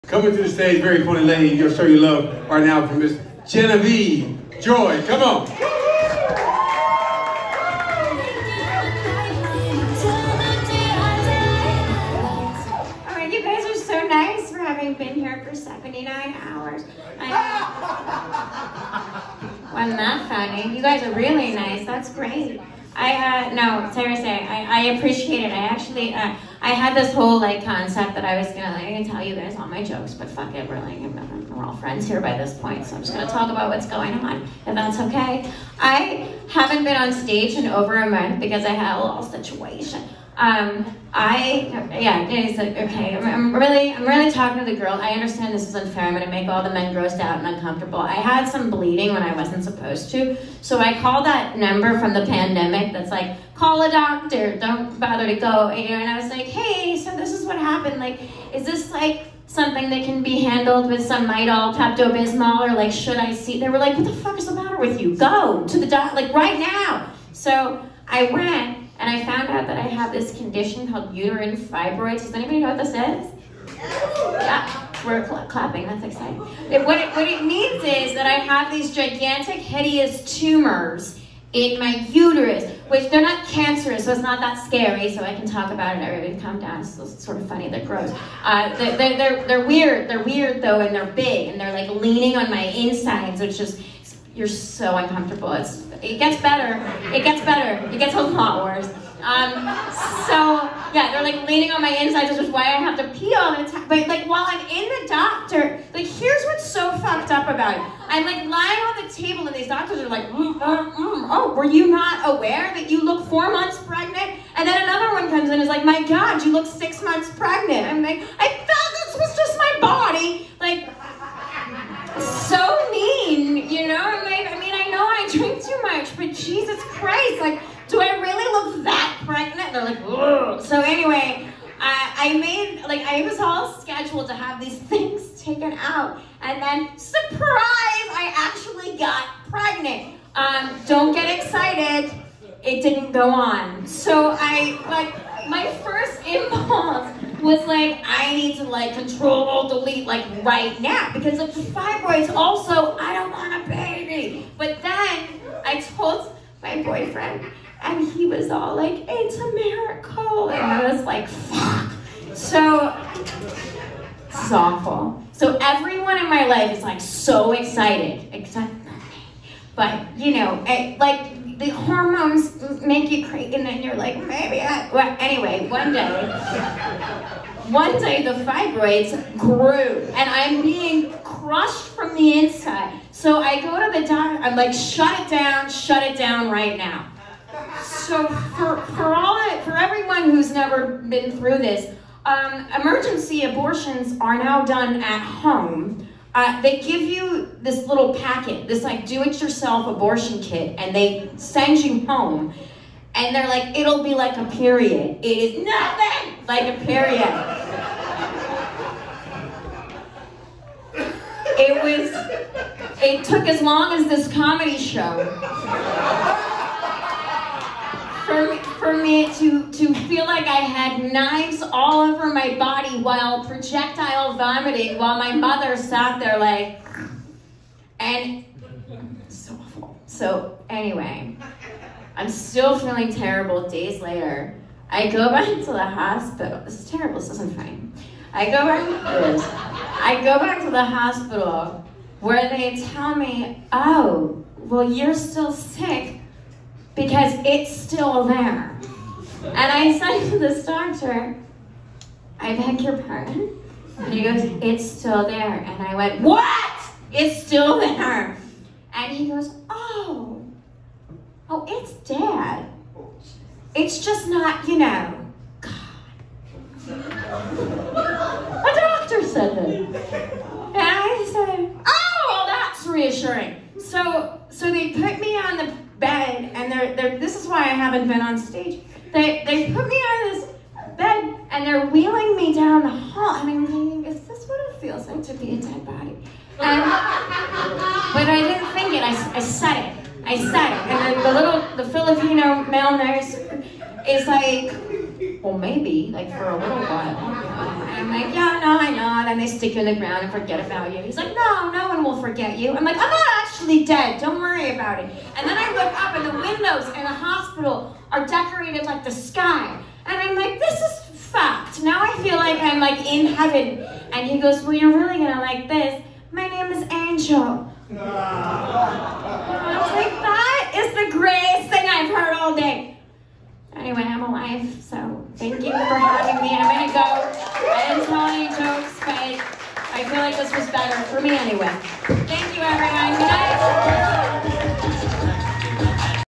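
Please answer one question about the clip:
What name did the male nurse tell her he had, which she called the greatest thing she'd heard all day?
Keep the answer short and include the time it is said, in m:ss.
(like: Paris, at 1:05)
Angel, at 5:16.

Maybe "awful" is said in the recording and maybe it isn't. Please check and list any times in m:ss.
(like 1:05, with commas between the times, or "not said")
2:44, 3:49.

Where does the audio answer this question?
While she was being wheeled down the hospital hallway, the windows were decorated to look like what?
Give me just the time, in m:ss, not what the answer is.
5:09.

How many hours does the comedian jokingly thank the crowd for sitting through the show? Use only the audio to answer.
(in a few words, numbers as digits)
79.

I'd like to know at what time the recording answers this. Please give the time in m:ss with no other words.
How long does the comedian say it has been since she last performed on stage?
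0:37.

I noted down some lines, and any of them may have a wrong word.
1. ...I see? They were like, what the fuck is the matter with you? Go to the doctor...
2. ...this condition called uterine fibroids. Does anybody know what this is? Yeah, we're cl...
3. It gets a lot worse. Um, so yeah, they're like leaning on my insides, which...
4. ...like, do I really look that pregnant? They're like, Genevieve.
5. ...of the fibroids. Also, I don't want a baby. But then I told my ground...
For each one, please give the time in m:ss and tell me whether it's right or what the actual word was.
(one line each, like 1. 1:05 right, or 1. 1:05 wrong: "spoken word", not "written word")
1. 1:03 right
2. 1:10 right
3. 1:37 right
4. 2:07 wrong: "Ugh", not "Genevieve"
5. 2:31 wrong: "boyfriend", not "ground".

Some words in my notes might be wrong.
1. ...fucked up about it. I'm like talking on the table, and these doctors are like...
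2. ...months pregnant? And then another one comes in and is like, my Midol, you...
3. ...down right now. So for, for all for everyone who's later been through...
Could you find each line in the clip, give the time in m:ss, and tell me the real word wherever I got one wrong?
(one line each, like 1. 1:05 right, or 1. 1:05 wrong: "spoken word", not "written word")
1. 1:46 wrong: "lying", not "talking"
2. 1:53 wrong: "God", not "Midol"
3. 3:06 wrong: "never", not "later".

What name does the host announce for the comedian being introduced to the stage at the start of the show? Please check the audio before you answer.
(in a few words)
Genevieve Joy.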